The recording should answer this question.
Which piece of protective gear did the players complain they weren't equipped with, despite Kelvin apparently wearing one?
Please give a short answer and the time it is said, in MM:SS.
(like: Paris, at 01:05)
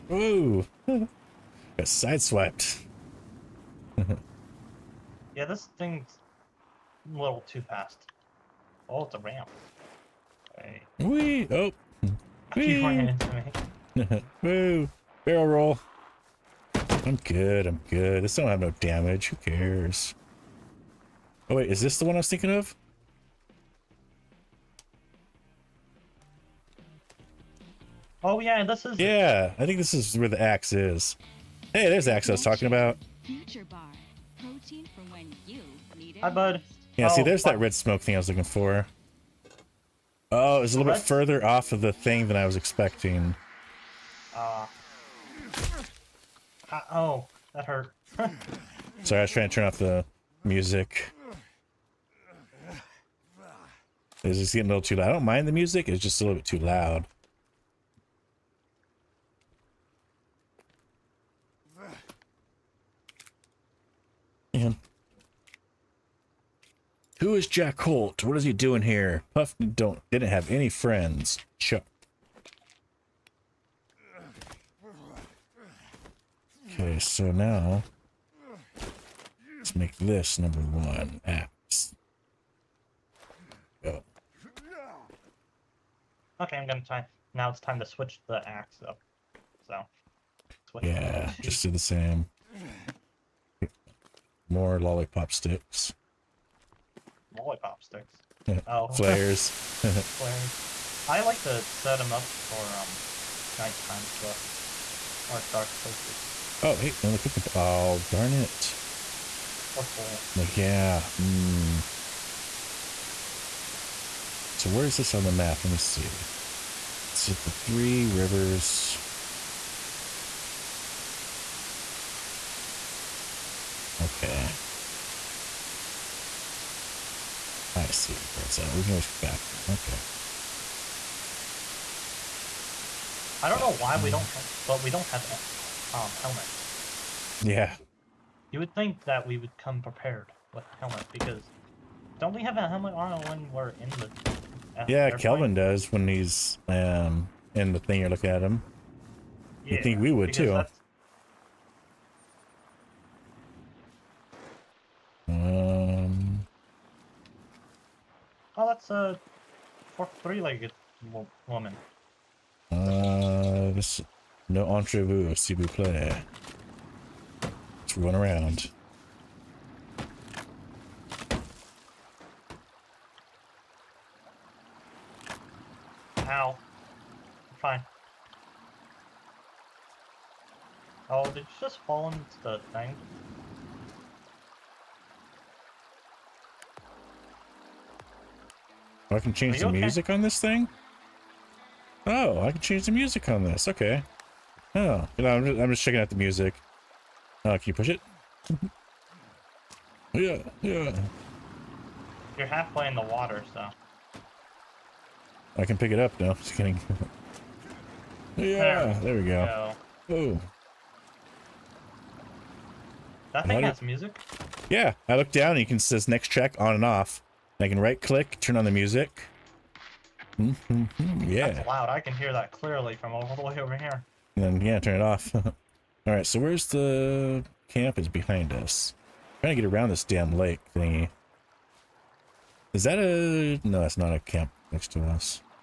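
Helmets, at 02:16.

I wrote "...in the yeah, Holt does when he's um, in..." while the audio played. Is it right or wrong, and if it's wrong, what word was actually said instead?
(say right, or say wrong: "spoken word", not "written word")
wrong: "Kelvin", not "Holt".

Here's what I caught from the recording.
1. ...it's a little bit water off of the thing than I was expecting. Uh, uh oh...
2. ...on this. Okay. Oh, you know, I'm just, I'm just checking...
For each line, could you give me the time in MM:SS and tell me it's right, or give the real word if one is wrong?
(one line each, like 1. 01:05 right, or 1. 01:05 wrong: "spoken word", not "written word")
1. 00:40 wrong: "further", not "water"
2. 03:13 right.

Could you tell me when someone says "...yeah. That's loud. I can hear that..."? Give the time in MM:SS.
03:41.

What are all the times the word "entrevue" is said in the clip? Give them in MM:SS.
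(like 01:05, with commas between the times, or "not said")
02:44.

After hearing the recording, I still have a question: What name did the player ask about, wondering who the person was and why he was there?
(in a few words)
Jack Holt.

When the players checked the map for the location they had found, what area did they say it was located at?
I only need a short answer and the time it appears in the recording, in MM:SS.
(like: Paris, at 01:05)
Three Rivers, at 01:57.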